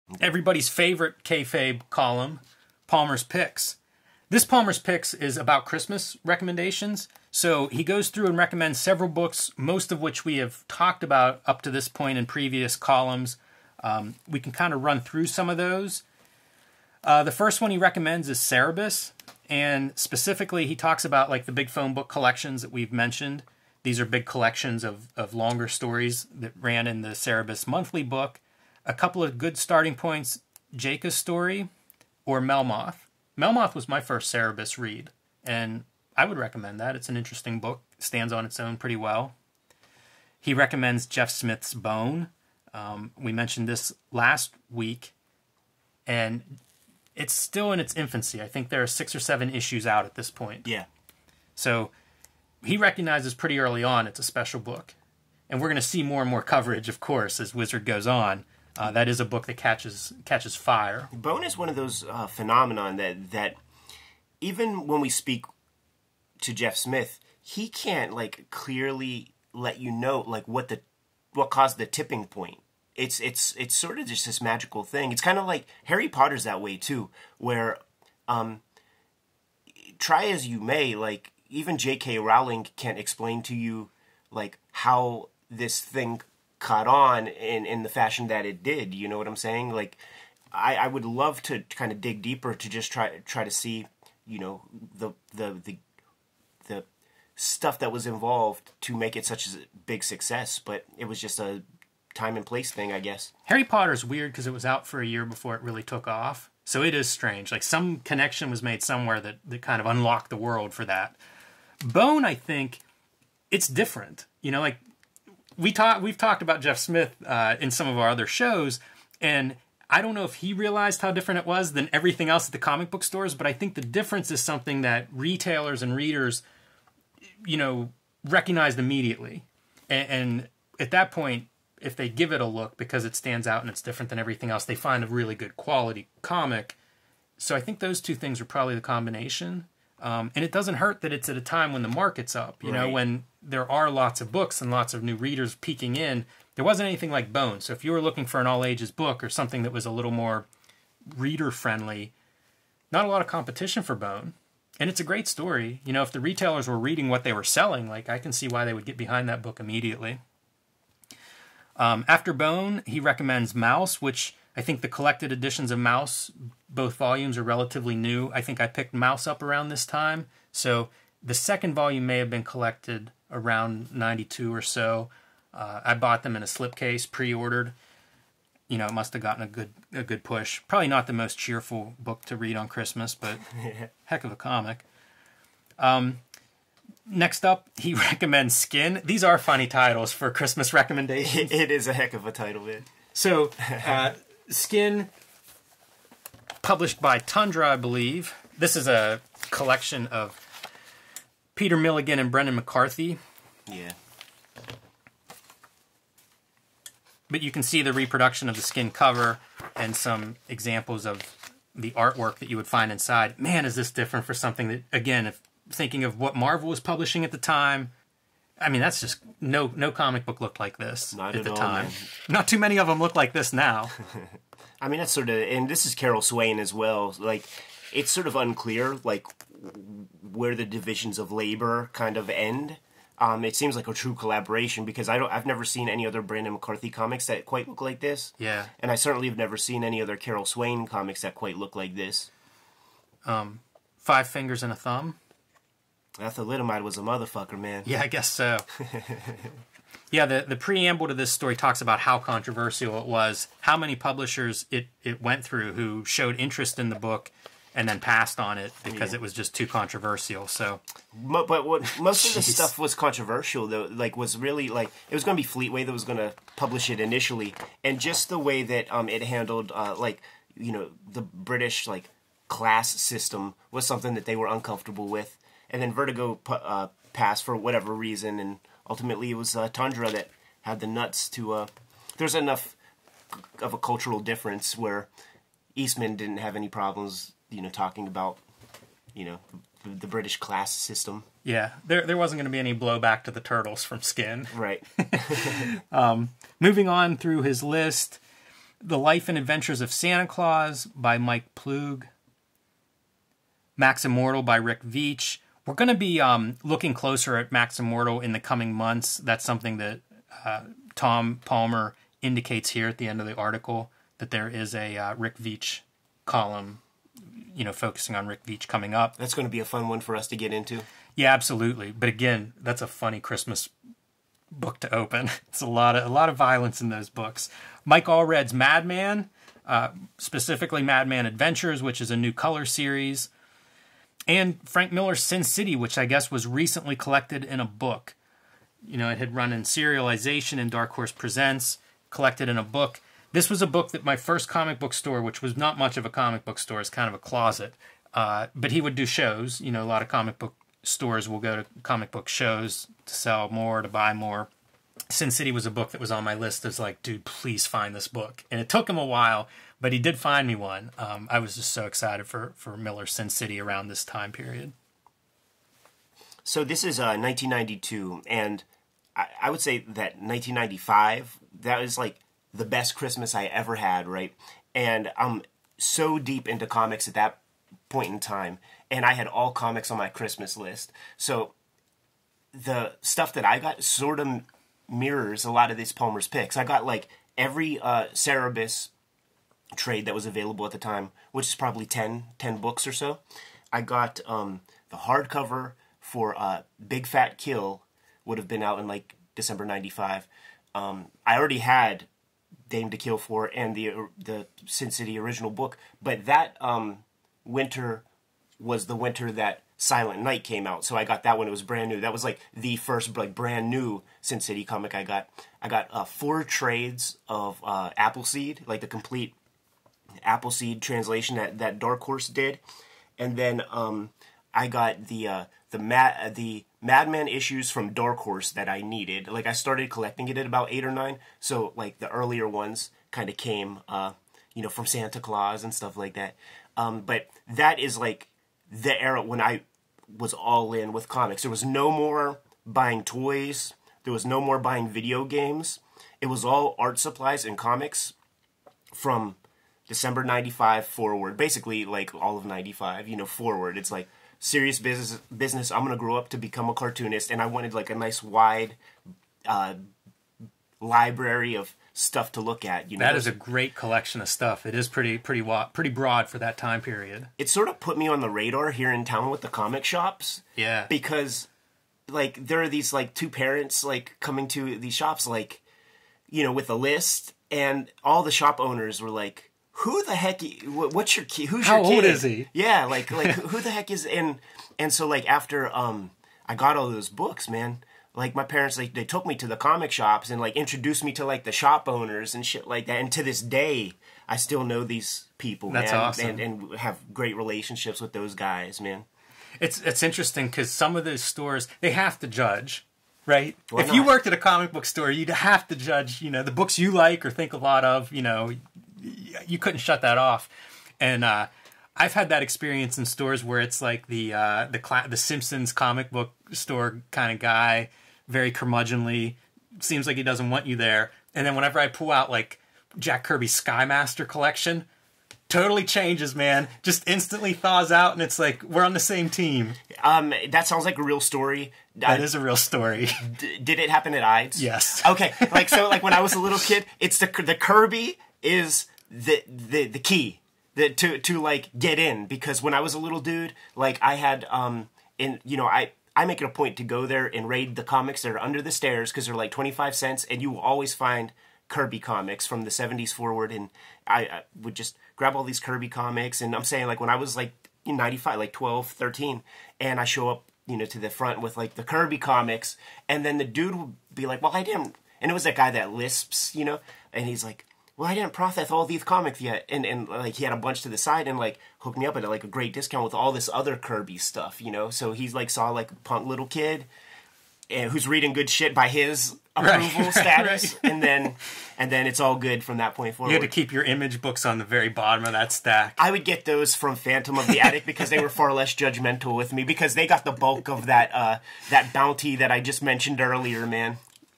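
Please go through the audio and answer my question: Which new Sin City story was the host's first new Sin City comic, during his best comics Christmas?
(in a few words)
Silent Night.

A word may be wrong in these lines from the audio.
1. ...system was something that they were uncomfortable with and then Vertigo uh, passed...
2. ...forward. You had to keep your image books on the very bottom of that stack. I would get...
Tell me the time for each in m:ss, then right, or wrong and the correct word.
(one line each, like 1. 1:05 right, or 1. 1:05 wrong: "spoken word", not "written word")
1. 4:32 right
2. 9:43 right.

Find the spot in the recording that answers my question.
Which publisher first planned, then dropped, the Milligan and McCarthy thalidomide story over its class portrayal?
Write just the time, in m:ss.
4:25.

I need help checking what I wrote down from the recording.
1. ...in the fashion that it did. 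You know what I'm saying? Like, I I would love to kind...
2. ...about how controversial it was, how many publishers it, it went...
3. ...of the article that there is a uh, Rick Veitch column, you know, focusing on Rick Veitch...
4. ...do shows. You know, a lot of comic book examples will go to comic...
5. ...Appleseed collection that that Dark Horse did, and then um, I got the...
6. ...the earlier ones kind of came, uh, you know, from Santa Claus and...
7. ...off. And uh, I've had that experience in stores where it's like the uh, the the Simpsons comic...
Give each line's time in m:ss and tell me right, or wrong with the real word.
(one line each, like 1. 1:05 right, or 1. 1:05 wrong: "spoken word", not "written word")
1. 1:27 right
2. 4:11 right
3. 5:13 right
4. 5:48 wrong: "stores", not "examples"
5. 7:00 wrong: "translation", not "collection"
6. 7:11 right
7. 8:30 right.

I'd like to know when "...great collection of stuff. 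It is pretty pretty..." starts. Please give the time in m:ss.
7:43.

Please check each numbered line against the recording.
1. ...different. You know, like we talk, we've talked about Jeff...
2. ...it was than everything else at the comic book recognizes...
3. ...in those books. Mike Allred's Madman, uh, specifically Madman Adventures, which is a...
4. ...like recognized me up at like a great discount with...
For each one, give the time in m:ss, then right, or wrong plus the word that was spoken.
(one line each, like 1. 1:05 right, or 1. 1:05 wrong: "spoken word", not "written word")
1. 1:53 right
2. 2:01 wrong: "stores", not "recognizes"
3. 5:26 right
4. 9:31 wrong: "hooked", not "recognized".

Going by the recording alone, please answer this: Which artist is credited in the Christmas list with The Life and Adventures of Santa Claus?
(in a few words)
Mike Ploog.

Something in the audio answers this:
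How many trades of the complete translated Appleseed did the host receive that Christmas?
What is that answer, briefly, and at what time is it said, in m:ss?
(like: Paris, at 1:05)
4, at 6:56.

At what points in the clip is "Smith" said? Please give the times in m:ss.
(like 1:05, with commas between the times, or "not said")
0:41, 1:06, 1:56.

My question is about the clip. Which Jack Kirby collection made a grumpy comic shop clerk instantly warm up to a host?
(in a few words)
Sky Master.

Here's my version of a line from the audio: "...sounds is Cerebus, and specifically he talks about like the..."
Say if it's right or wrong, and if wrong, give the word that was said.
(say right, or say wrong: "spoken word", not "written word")
wrong: "recommends", not "sounds".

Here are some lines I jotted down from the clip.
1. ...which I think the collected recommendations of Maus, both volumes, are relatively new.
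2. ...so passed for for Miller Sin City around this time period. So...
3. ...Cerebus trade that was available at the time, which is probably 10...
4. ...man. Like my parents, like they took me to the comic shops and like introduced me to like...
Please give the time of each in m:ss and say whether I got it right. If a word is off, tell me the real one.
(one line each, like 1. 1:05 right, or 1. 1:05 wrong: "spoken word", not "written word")
1. 2:44 wrong: "editions", not "recommendations"
2. 6:01 wrong: "excited", not "passed"
3. 6:28 right
4. 8:07 right.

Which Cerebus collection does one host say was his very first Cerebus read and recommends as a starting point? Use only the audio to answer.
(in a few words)
Melmoth.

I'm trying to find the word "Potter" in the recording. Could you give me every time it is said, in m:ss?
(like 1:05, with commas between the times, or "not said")
1:16, 1:43.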